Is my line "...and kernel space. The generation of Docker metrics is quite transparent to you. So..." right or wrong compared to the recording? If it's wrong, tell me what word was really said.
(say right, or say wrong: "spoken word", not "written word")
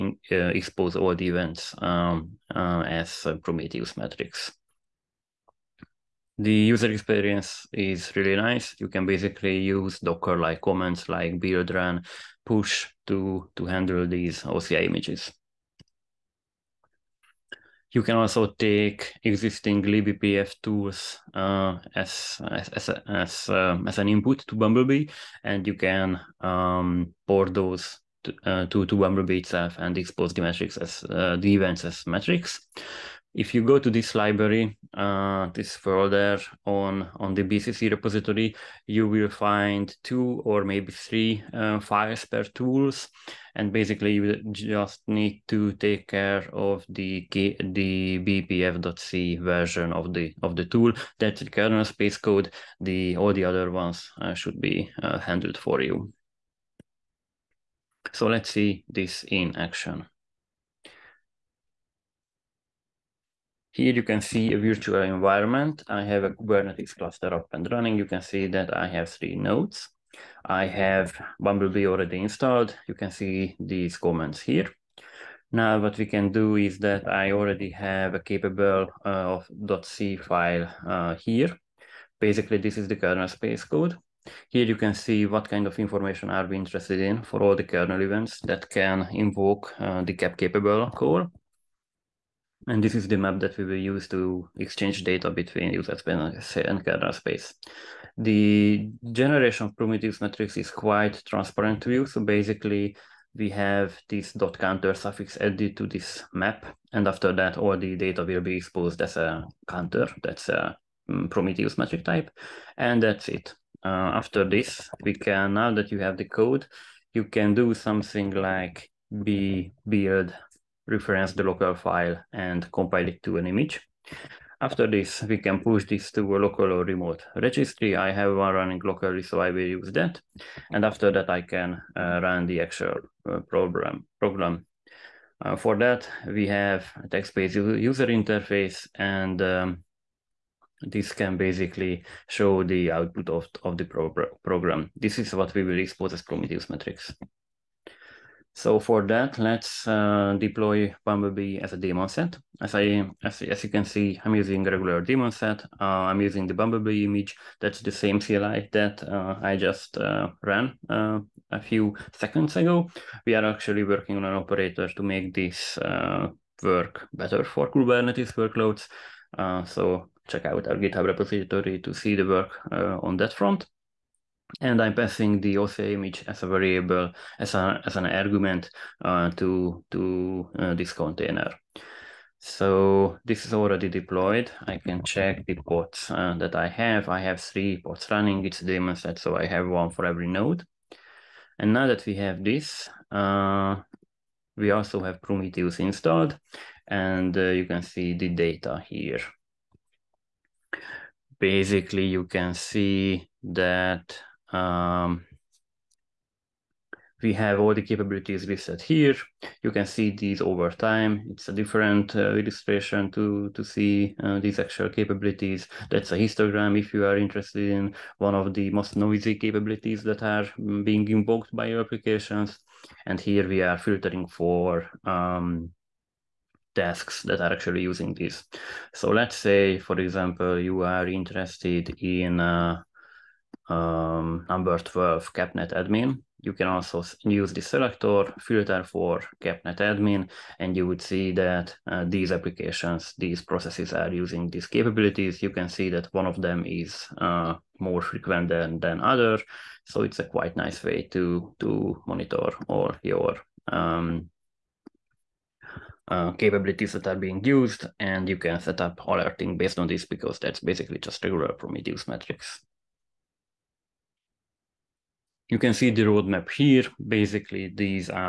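wrong: "Prometheus", not "Docker".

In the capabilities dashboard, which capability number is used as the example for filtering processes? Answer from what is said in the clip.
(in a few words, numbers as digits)
12.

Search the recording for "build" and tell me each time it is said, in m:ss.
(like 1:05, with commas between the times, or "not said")
0:11, 1:59.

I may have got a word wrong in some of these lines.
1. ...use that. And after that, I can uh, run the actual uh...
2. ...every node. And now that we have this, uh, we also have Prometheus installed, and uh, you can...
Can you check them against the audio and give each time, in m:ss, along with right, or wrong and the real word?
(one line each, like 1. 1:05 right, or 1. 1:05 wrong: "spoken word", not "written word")
1. 2:09 right
2. 3:10 right.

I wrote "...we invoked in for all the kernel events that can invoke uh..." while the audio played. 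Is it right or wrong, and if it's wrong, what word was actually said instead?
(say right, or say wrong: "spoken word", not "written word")
wrong: "interested", not "invoked".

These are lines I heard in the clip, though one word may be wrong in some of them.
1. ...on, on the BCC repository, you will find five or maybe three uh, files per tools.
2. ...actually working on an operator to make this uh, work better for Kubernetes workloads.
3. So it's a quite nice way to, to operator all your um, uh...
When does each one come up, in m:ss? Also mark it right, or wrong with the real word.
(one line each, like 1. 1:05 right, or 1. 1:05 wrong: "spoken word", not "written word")
1. 0:36 wrong: "two", not "five"
2. 2:43 right
3. 4:09 wrong: "monitor", not "operator".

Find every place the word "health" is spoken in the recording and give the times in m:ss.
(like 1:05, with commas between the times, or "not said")
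not said.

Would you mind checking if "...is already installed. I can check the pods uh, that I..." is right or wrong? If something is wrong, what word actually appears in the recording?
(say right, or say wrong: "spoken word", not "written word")
wrong: "deployed", not "installed".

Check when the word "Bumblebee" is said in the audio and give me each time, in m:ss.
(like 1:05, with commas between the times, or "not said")
0:24, 0:28, 1:11, 2:31, 2:36.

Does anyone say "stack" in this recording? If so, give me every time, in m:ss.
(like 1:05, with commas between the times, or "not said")
not said.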